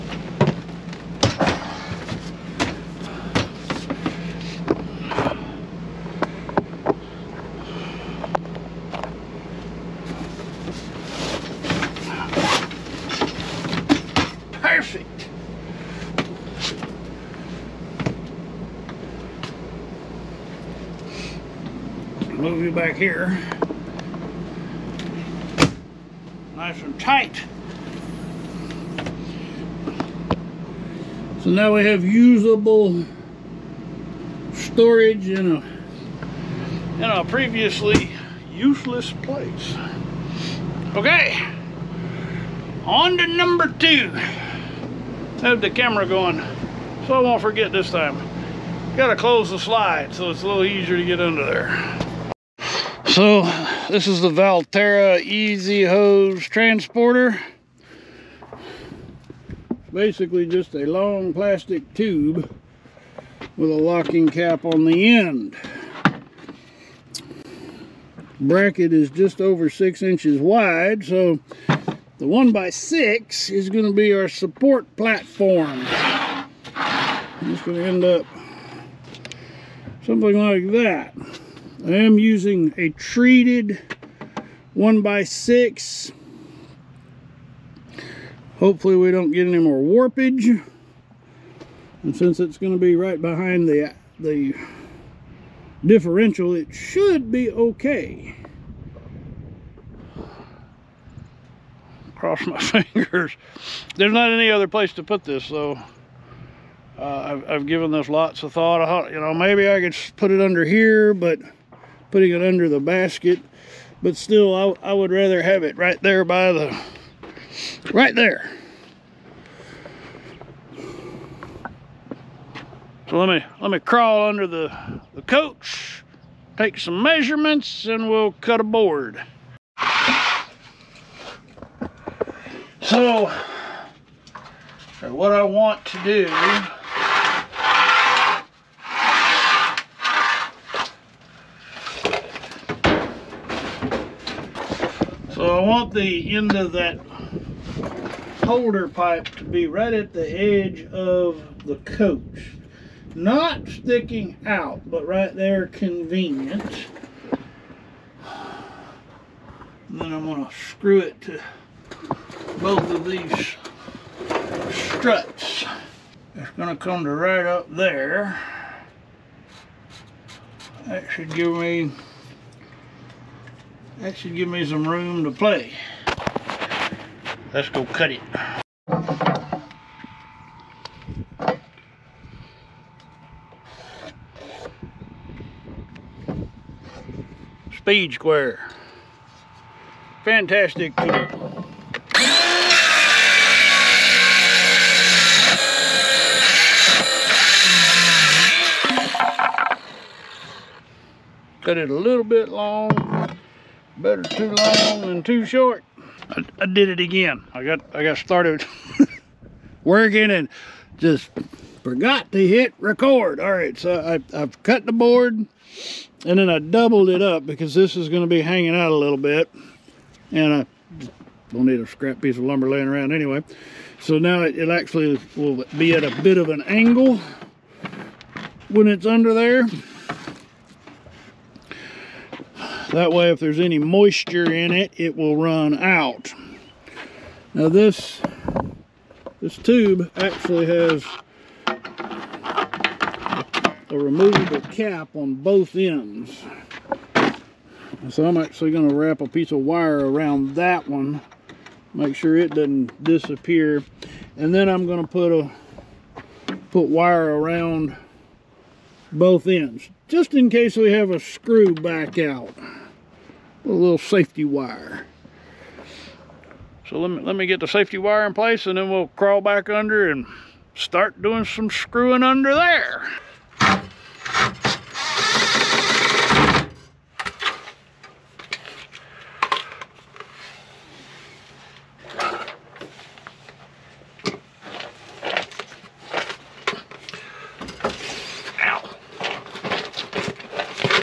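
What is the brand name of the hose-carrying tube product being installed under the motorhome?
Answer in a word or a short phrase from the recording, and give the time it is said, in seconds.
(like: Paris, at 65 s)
Valterra, at 54 s.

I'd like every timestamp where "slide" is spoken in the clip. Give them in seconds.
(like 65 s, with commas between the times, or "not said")
49 s.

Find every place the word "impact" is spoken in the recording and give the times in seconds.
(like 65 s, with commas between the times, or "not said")
not said.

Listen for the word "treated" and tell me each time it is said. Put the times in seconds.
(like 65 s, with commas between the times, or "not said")
82 s.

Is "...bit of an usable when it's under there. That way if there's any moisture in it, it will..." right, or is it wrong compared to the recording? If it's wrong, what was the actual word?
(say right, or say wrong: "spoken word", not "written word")
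wrong: "angle", not "usable".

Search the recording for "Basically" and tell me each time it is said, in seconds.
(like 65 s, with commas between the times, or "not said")
59 s.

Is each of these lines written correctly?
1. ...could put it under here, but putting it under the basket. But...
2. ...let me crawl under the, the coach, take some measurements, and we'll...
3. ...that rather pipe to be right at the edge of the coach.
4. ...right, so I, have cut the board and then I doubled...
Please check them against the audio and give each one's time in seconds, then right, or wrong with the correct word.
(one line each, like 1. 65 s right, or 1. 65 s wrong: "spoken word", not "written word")
1. 109 s right
2. 123 s right
3. 146 s wrong: "holder", not "rather"
4. 213 s right.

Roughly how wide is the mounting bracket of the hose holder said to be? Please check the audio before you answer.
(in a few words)
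just over 6 inches.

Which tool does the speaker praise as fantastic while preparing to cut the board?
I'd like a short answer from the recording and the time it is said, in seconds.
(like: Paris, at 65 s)
Speed Square, at 187 s.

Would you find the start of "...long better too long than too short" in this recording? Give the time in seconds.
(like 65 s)
202 s.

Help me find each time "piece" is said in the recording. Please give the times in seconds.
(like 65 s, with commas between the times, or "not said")
222 s, 249 s.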